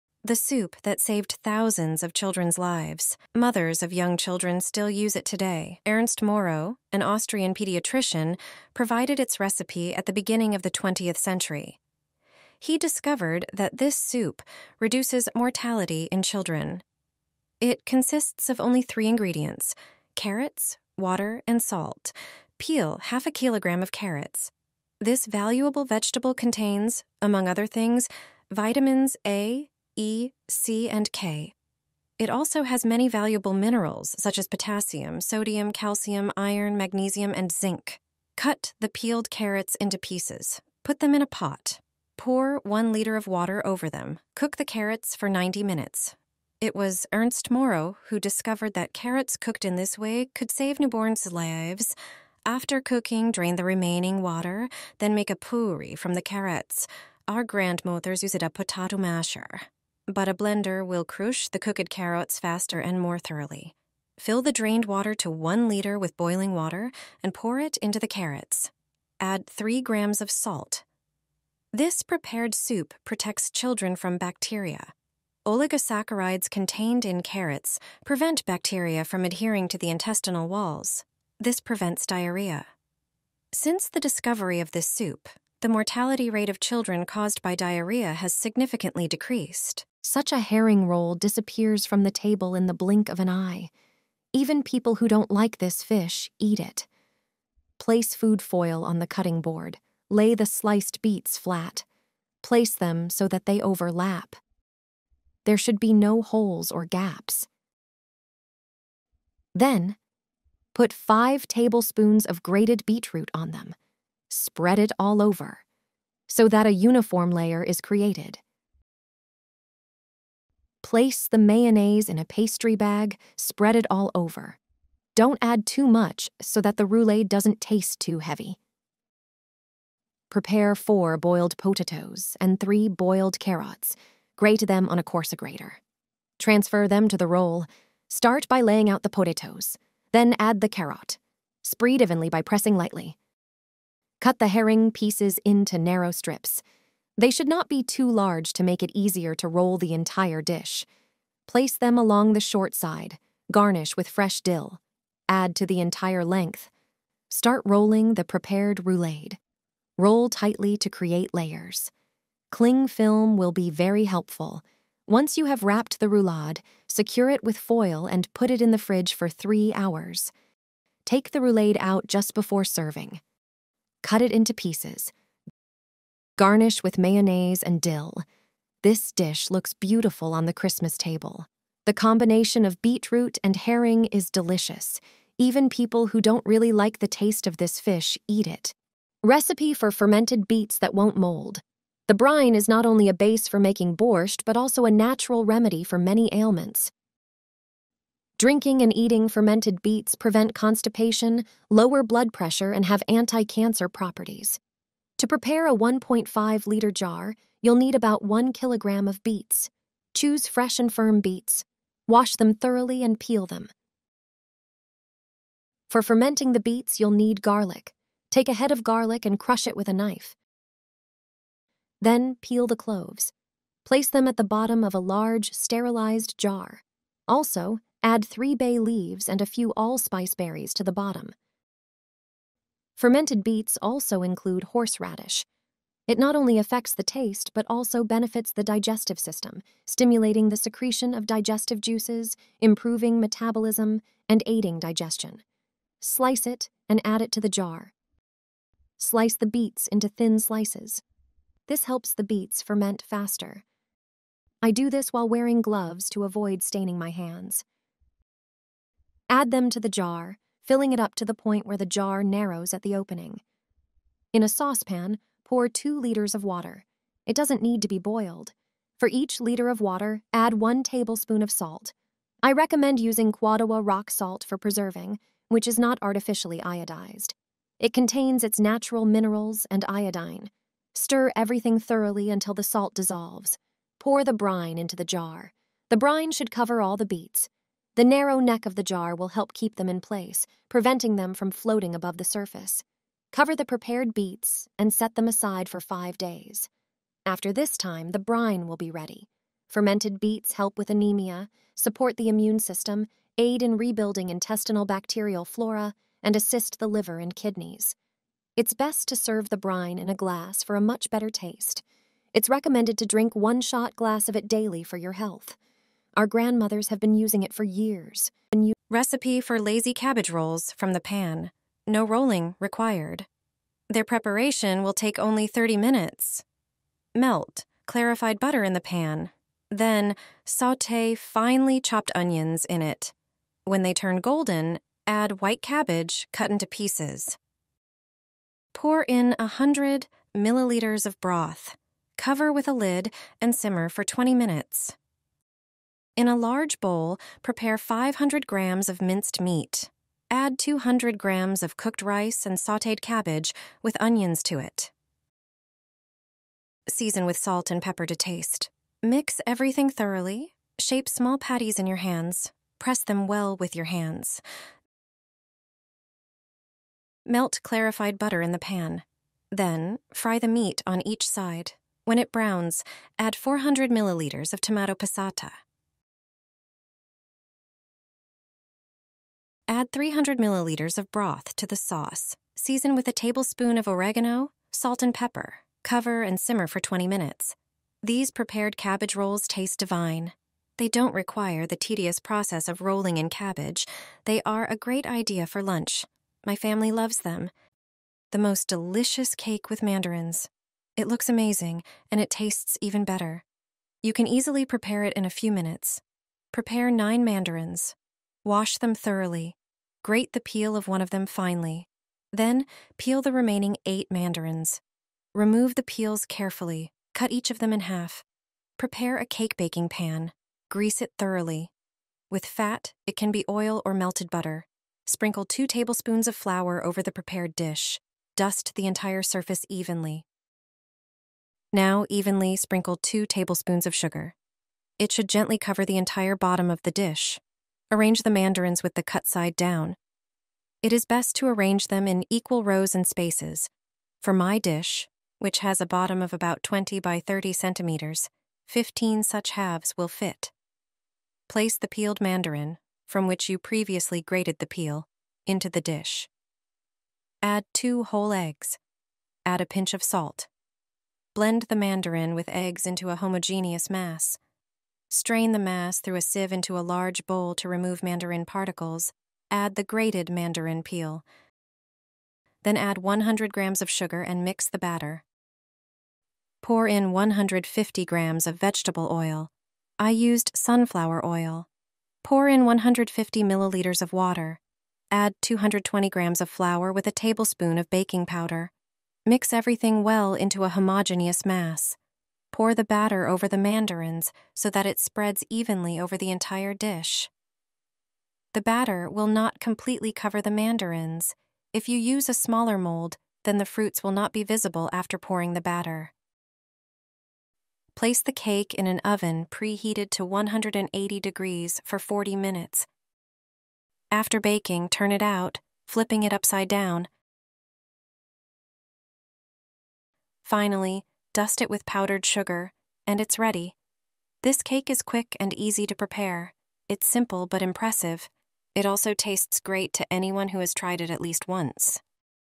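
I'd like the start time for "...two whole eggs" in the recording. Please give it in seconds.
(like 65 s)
457 s.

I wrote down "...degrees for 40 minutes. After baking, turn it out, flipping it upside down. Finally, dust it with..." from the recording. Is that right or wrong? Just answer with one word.
right.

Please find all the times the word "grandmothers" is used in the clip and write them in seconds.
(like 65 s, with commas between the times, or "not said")
57 s, 316 s.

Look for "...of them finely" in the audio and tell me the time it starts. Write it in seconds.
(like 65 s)
411 s.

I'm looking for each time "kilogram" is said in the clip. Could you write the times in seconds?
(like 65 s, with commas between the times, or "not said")
23 s, 208 s.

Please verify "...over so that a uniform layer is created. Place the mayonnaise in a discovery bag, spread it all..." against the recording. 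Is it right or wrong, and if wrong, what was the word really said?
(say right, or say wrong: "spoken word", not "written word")
wrong: "pastry", not "discovery".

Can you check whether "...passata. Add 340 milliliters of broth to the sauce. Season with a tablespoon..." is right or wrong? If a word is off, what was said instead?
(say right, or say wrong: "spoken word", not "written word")
wrong: "300", not "340".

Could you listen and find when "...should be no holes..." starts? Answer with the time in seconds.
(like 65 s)
105 s.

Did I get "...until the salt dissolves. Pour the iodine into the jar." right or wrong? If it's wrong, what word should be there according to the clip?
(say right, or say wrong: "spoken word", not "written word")
wrong: "brine", not "iodine".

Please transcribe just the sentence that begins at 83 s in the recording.
Since the discovery of this soup, the mortality rate of children caused by diarrhea has significantly decreased.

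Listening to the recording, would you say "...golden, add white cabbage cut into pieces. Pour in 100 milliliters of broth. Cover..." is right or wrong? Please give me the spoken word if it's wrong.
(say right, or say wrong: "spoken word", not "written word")
right.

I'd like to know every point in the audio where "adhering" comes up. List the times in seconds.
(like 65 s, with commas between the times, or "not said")
79 s.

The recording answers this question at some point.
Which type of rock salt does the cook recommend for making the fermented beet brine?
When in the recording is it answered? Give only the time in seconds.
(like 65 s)
273 s.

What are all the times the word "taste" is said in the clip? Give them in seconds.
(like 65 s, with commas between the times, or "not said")
127 s, 187 s, 237 s, 311 s, 358 s, 389 s, 402 s, 529 s.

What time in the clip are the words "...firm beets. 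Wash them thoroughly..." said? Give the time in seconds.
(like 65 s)
210 s.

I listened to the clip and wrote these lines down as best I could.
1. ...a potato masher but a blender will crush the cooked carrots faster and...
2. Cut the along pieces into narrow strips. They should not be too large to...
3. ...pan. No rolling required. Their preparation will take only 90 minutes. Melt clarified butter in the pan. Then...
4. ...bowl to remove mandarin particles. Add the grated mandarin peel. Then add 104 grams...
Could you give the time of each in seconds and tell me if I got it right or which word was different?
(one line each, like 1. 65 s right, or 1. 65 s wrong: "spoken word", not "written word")
1. 58 s right
2. 144 s wrong: "herring", not "along"
3. 320 s wrong: "30", not "90"
4. 467 s wrong: "100", not "104".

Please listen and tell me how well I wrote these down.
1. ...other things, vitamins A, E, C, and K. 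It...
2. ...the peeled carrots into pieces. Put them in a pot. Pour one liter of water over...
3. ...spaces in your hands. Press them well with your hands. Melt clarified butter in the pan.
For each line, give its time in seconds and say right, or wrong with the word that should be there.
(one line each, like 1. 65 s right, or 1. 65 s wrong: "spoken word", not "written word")
1. 27 s right
2. 38 s right
3. 361 s wrong: "patties", not "spaces".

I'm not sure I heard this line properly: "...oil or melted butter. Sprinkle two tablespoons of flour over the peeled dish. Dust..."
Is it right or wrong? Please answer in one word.
wrong.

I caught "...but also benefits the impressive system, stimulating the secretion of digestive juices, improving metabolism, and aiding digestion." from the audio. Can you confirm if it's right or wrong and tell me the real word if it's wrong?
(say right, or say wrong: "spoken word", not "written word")
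wrong: "digestive", not "impressive".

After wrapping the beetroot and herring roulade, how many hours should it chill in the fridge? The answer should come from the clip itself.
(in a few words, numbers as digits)
3 hours.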